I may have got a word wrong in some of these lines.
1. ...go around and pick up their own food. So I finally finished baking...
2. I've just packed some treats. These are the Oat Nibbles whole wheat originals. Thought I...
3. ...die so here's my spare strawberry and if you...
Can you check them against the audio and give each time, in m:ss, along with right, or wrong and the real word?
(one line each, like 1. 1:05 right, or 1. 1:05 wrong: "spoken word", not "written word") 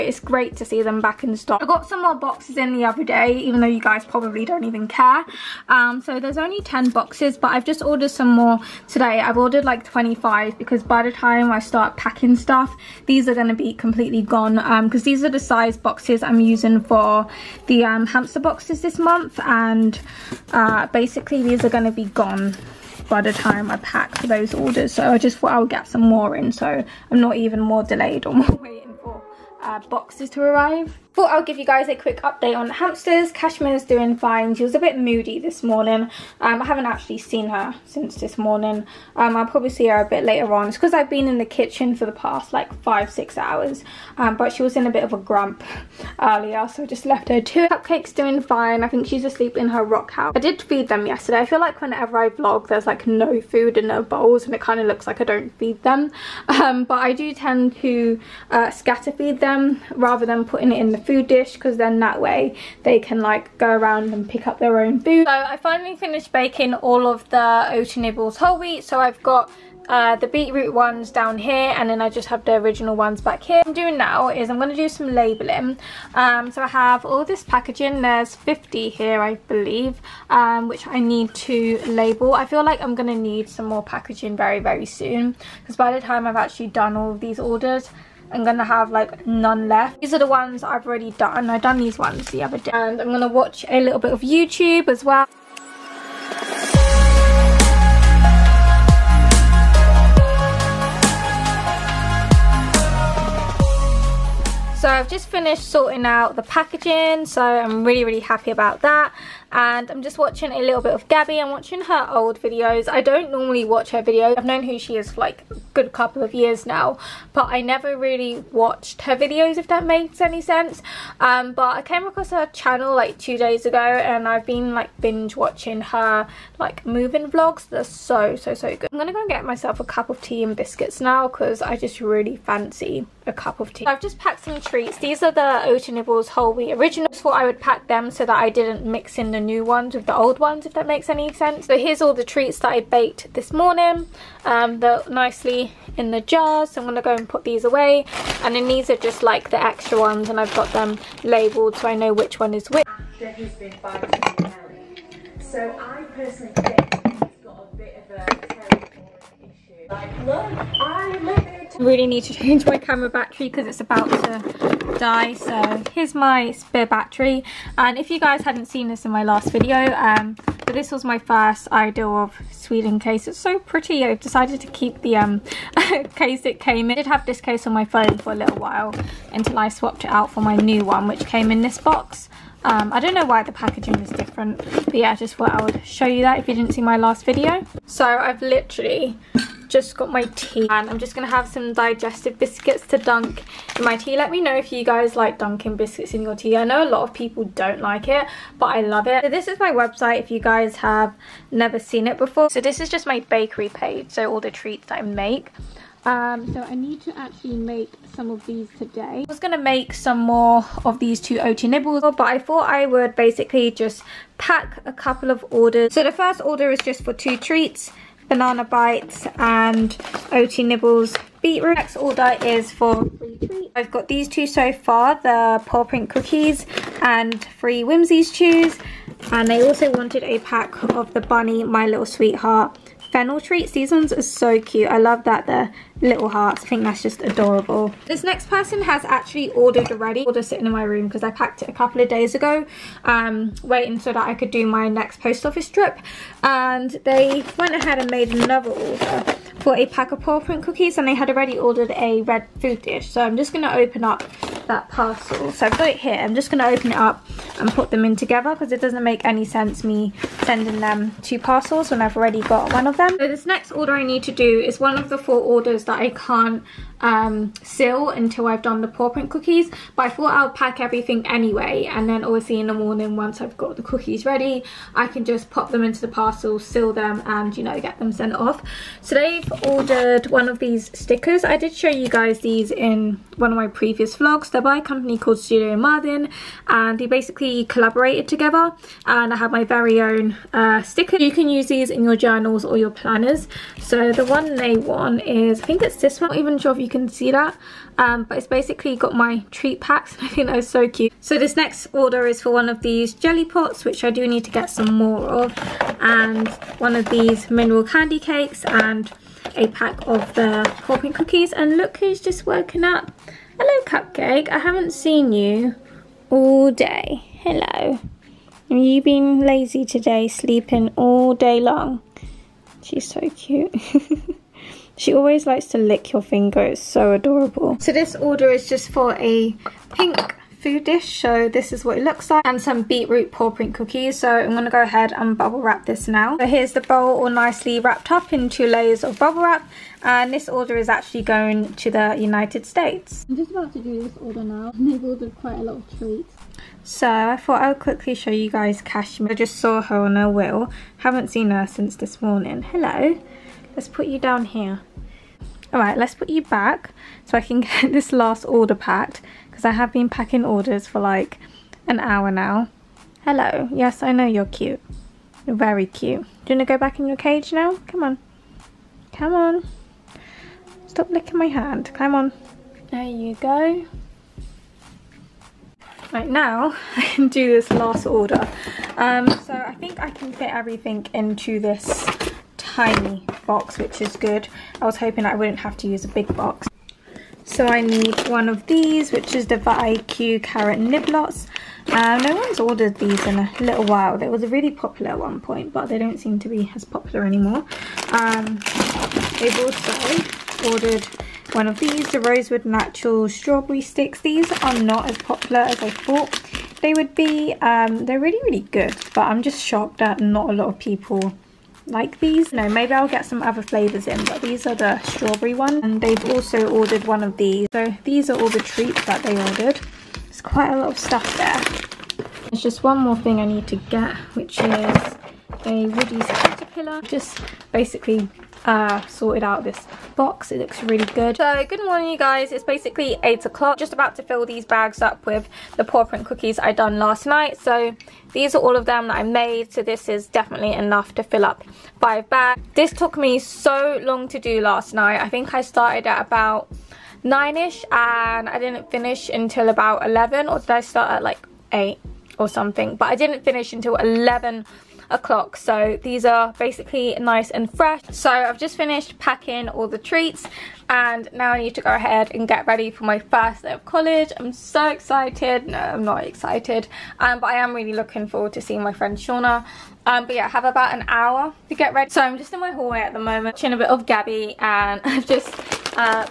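1. 1:03 right
2. 2:13 right
3. 2:44 wrong: "battery", not "strawberry".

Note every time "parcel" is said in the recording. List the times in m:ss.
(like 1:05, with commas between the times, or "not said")
4:14, 4:21, 4:36.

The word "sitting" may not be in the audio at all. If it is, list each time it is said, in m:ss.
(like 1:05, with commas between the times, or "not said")
4:00.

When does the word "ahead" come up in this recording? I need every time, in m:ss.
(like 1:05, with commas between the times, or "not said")
4:07, 5:34, 7:41.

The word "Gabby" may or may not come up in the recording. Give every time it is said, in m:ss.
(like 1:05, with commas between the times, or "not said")
1:51, 7:54.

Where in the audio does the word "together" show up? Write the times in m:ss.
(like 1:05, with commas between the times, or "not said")
4:18, 4:48.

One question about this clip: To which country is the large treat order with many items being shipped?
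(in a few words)
United States.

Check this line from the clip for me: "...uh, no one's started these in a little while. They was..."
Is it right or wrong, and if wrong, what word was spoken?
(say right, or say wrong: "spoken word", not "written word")
wrong: "ordered", not "started".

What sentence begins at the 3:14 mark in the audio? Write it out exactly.
Let me know if you guys like dunking biscuits in your tea.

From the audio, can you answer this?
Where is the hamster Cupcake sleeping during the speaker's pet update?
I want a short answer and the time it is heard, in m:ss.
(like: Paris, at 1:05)
her rock house, at 0:49.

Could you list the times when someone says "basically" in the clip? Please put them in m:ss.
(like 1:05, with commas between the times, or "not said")
0:20, 3:33, 4:47, 4:58, 7:07, 7:12, 7:36.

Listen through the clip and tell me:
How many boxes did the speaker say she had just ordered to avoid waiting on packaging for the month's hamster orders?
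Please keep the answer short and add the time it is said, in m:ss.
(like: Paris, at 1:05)
25, at 0:09.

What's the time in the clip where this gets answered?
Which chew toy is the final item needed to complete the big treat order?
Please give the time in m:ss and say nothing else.
7:05.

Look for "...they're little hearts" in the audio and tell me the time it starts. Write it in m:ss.
3:55.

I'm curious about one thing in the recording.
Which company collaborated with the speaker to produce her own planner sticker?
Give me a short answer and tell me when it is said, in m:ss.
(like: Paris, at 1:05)
Studio Martin, at 4:45.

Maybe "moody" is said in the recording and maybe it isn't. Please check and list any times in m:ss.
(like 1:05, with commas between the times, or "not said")
0:34.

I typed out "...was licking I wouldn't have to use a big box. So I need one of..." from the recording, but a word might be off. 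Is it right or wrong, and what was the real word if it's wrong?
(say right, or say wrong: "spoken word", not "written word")
wrong: "hoping", not "licking".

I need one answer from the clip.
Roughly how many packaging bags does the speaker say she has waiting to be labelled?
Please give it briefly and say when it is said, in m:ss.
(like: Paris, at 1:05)
50, at 1:18.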